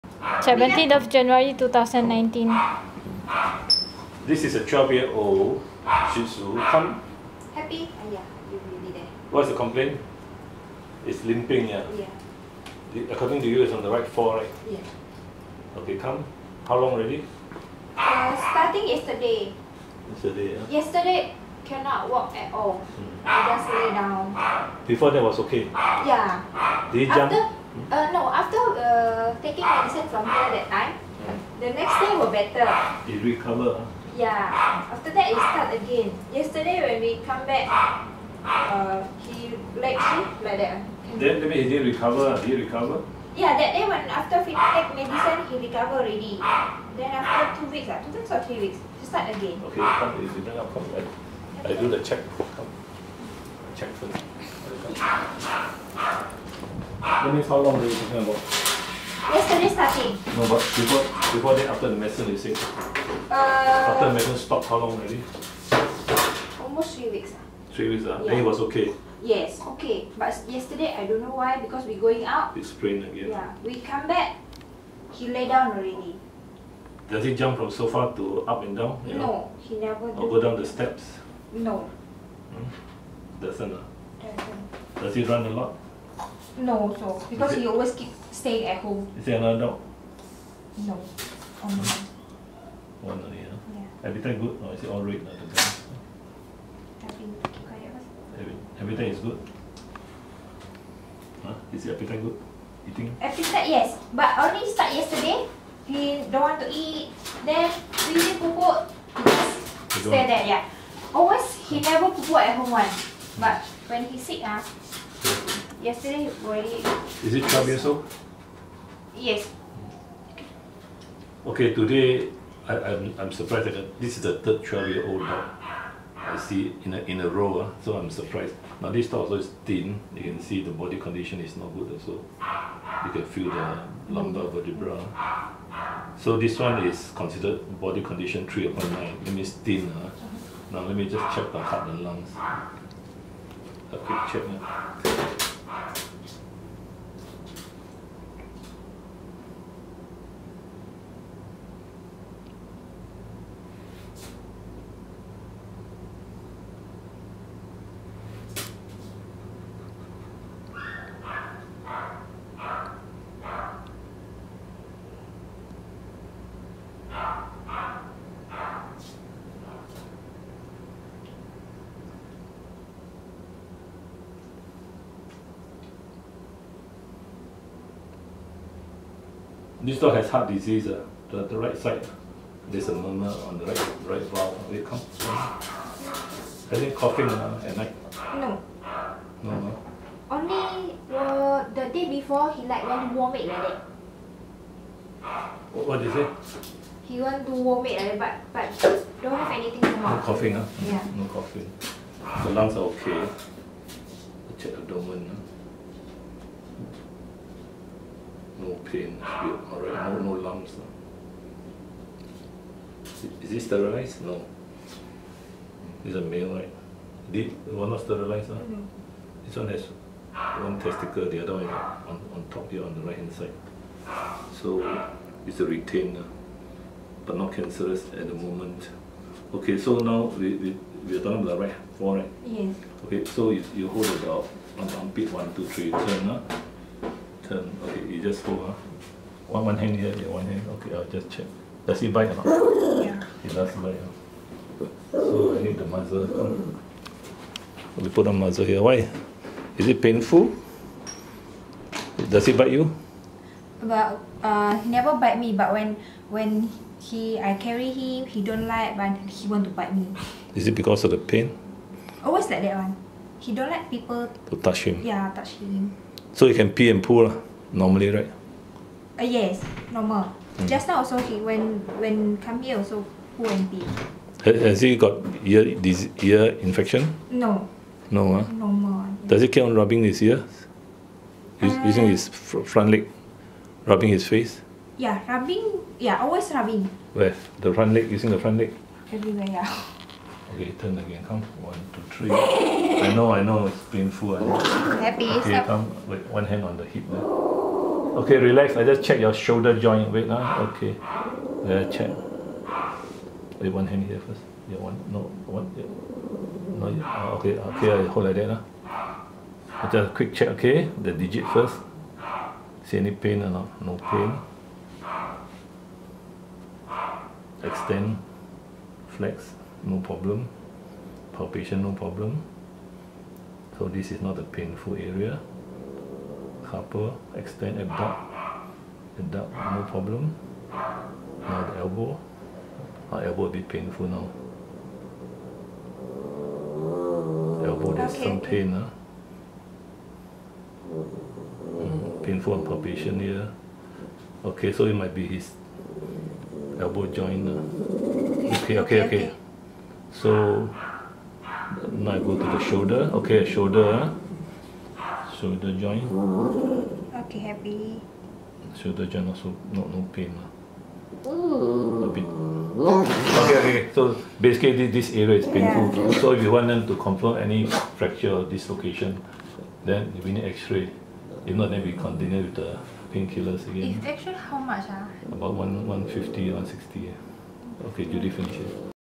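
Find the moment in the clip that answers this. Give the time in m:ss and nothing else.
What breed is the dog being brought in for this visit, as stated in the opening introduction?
0:06.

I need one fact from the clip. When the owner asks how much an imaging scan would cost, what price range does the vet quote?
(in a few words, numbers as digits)
150 to 160.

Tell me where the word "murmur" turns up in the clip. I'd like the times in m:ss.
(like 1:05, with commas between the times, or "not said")
3:02.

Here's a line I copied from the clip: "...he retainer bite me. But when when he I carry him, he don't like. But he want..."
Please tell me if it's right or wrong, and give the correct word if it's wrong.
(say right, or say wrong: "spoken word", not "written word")
wrong: "never", not "retainer".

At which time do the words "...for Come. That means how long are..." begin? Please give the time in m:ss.
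0:53.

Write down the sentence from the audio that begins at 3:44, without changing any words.
So it's a retainer, but not cancerous at the moment.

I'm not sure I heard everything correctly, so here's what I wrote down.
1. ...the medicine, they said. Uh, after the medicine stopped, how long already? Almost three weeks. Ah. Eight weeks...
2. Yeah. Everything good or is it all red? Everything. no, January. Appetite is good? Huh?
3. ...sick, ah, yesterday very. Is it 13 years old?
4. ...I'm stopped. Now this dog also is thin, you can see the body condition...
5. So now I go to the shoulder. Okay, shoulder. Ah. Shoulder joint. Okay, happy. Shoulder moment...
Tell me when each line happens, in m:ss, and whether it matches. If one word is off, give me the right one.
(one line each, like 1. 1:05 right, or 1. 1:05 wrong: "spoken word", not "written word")
1. 1:01 wrong: "Three", not "Eight"
2. 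1:33 wrong: "Appetite", not "January"
3. 1:54 wrong: "12", not "13"
4. 2:07 wrong: "surprised", not "stopped"
5. 5:50 wrong: "joint", not "moment".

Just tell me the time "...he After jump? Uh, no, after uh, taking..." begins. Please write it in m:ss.
0:27.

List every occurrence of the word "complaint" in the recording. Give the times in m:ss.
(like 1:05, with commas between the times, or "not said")
0:09.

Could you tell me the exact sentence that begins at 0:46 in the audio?
Then after two weeks, uh, two weeks or three weeks, he start again.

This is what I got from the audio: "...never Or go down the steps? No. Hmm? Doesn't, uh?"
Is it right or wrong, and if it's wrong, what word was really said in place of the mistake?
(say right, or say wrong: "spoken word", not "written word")
right.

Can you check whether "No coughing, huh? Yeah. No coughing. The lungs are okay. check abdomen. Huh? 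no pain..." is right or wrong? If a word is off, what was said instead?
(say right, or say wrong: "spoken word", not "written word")
right.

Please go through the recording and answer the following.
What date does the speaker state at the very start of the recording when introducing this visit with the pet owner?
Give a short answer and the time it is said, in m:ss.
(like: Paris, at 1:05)
17 January 2019, at 0:00.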